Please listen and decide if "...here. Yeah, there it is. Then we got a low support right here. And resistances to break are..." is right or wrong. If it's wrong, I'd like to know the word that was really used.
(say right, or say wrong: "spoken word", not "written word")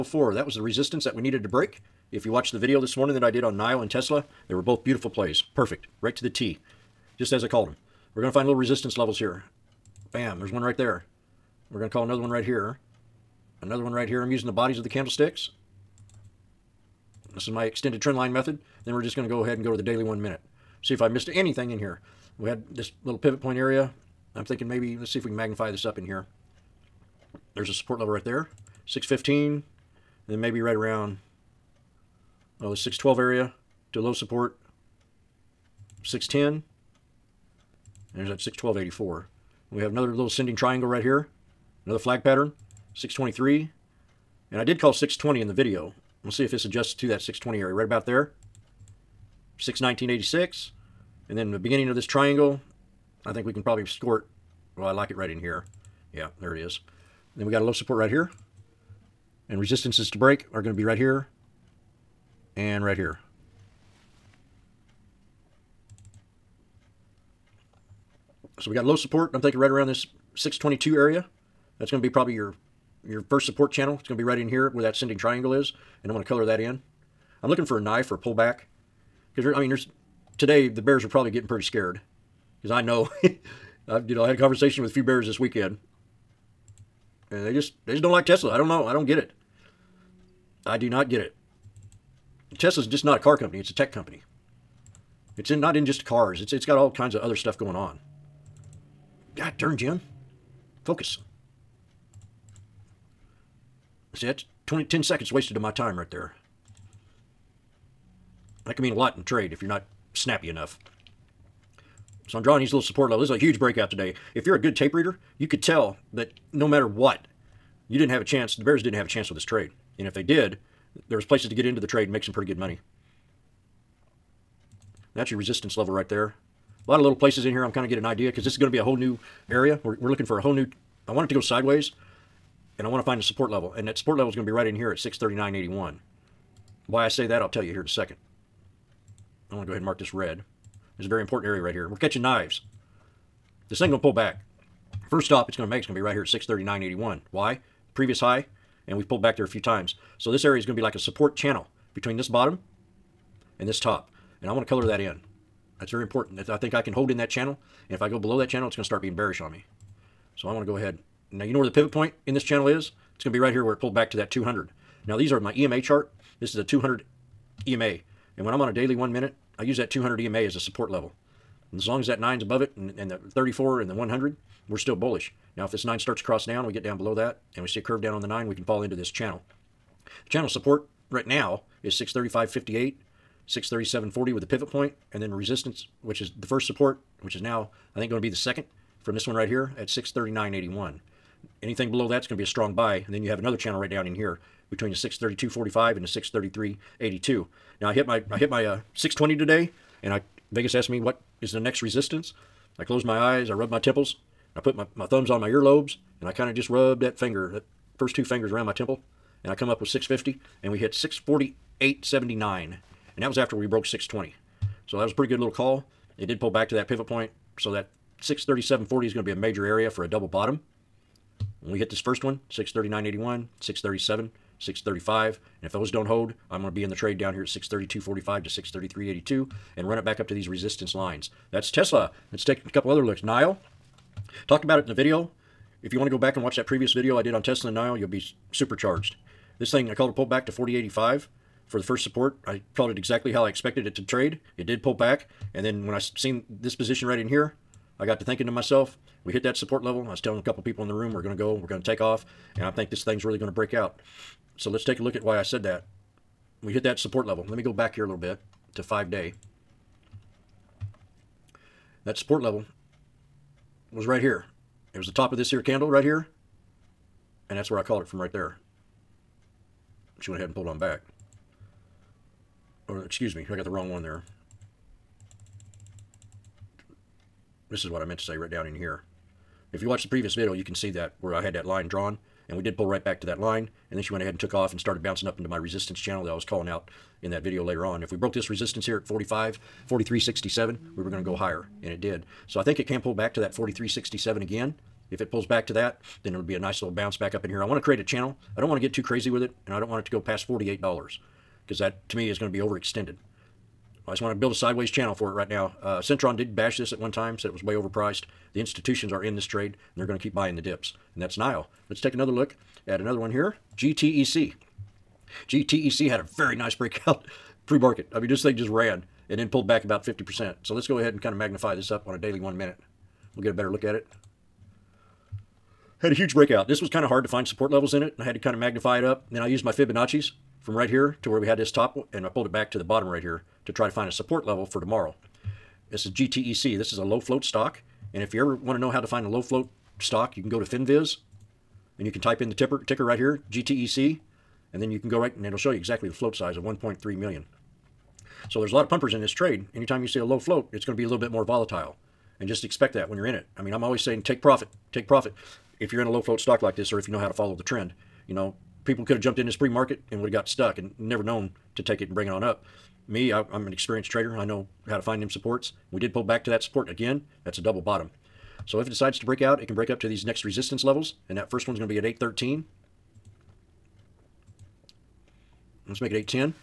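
right.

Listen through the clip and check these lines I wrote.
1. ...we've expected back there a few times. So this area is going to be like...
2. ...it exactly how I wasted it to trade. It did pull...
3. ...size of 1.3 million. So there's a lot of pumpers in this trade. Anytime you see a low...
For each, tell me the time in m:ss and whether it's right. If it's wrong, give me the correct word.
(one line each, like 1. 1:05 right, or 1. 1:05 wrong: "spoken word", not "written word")
1. 2:28 wrong: "pulled", not "expected"
2. 4:02 wrong: "expected", not "wasted"
3. 5:46 right.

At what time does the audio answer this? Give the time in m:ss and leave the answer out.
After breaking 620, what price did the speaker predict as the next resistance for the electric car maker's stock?
3:29.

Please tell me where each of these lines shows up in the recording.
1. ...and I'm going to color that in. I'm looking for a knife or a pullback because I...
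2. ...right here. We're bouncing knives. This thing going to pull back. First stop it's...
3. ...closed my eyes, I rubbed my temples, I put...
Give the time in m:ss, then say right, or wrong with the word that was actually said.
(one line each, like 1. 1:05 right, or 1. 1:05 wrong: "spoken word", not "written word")
1. 1:16 right
2. 2:21 wrong: "catching", not "bouncing"
3. 3:22 right.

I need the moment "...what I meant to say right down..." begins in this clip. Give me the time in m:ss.
4:37.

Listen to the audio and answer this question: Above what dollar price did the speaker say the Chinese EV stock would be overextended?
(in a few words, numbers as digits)
$48.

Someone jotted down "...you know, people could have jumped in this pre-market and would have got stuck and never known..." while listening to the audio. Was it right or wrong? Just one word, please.
right.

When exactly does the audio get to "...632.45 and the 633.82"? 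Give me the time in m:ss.
3:14.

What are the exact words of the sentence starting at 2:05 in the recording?
That's your resistance level right there.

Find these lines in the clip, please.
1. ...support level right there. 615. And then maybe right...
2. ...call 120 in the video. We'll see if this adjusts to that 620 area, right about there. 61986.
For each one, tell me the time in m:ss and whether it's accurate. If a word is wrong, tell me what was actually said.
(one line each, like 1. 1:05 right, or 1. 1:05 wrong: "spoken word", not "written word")
1. 0:27 right
2. 0:44 wrong: "620", not "120".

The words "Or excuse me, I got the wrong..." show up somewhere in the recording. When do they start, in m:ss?
4:32.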